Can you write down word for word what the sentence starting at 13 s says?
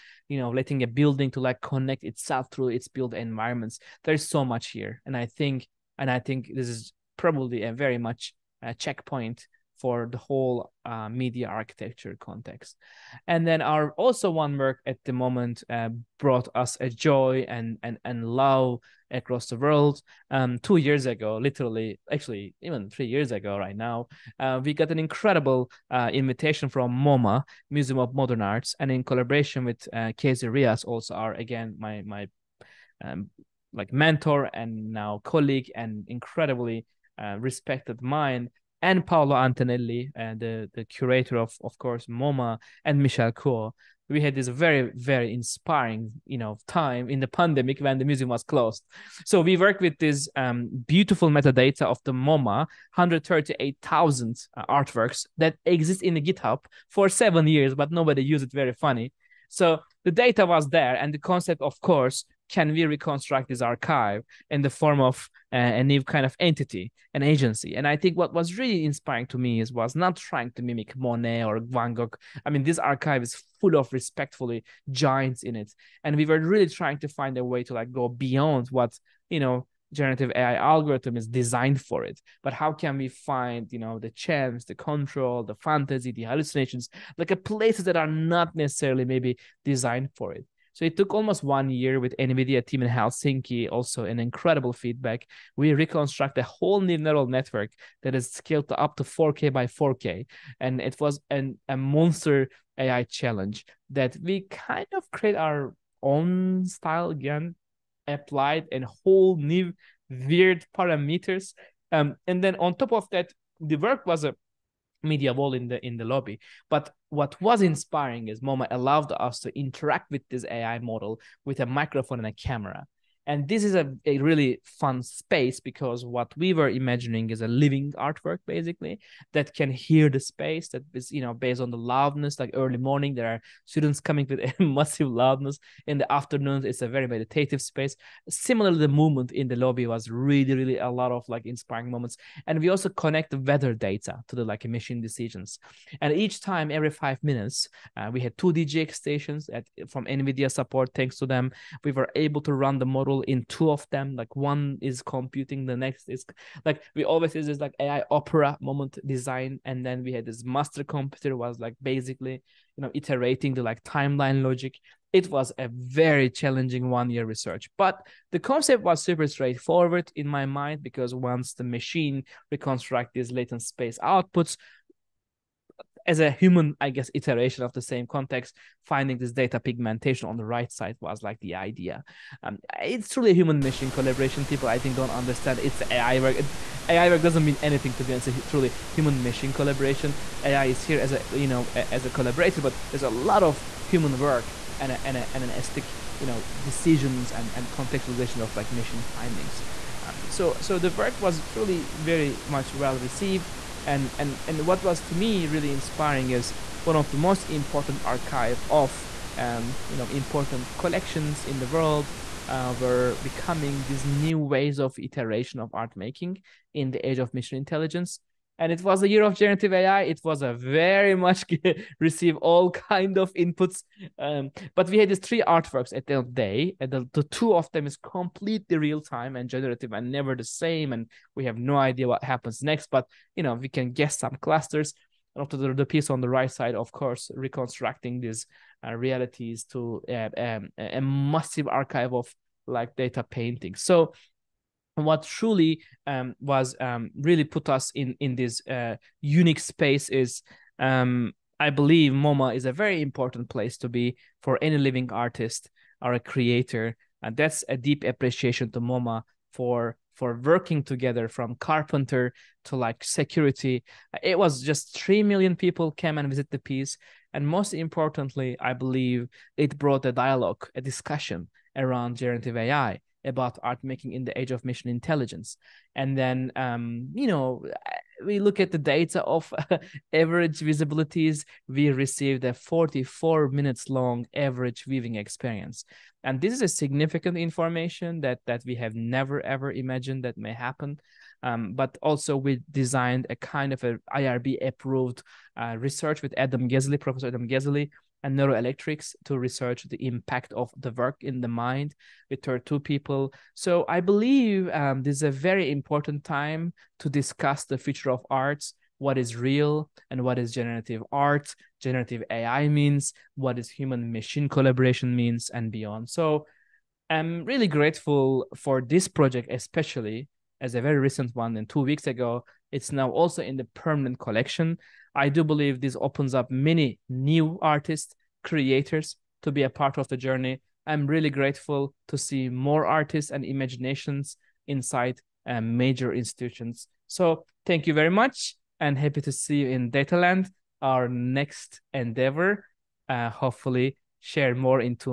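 And then our also one work at the moment uh, brought us a joy and and and love across the world.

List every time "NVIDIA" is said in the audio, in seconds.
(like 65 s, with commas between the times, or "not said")
92 s, 150 s.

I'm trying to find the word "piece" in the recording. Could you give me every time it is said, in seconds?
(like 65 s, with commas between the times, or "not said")
235 s, 266 s.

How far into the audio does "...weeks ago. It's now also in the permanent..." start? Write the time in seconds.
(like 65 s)
321 s.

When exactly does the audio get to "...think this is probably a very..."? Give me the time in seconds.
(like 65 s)
6 s.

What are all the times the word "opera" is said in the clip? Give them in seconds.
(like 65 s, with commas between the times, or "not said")
158 s.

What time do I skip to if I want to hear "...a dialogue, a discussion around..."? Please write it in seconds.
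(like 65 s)
270 s.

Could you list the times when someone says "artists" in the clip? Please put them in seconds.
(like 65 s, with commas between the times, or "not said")
255 s, 327 s, 332 s.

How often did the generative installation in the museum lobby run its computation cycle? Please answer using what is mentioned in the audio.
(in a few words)
Every 5 minutes.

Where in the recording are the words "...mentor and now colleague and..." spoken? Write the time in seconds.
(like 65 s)
33 s.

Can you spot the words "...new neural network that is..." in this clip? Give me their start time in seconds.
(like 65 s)
96 s.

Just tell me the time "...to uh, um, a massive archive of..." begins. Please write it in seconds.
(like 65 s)
239 s.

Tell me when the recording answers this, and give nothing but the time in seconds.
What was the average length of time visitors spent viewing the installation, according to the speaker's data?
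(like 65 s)
282 s.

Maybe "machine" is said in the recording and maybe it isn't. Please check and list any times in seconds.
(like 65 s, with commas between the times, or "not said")
171 s, 183 s, 189 s, 274 s, 314 s.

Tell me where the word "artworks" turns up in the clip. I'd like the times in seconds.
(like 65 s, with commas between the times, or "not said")
54 s, 127 s, 225 s.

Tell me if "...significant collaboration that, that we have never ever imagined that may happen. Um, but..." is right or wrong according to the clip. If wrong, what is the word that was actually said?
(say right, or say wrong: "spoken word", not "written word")
wrong: "information", not "collaboration".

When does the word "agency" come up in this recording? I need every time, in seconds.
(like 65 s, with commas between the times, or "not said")
67 s.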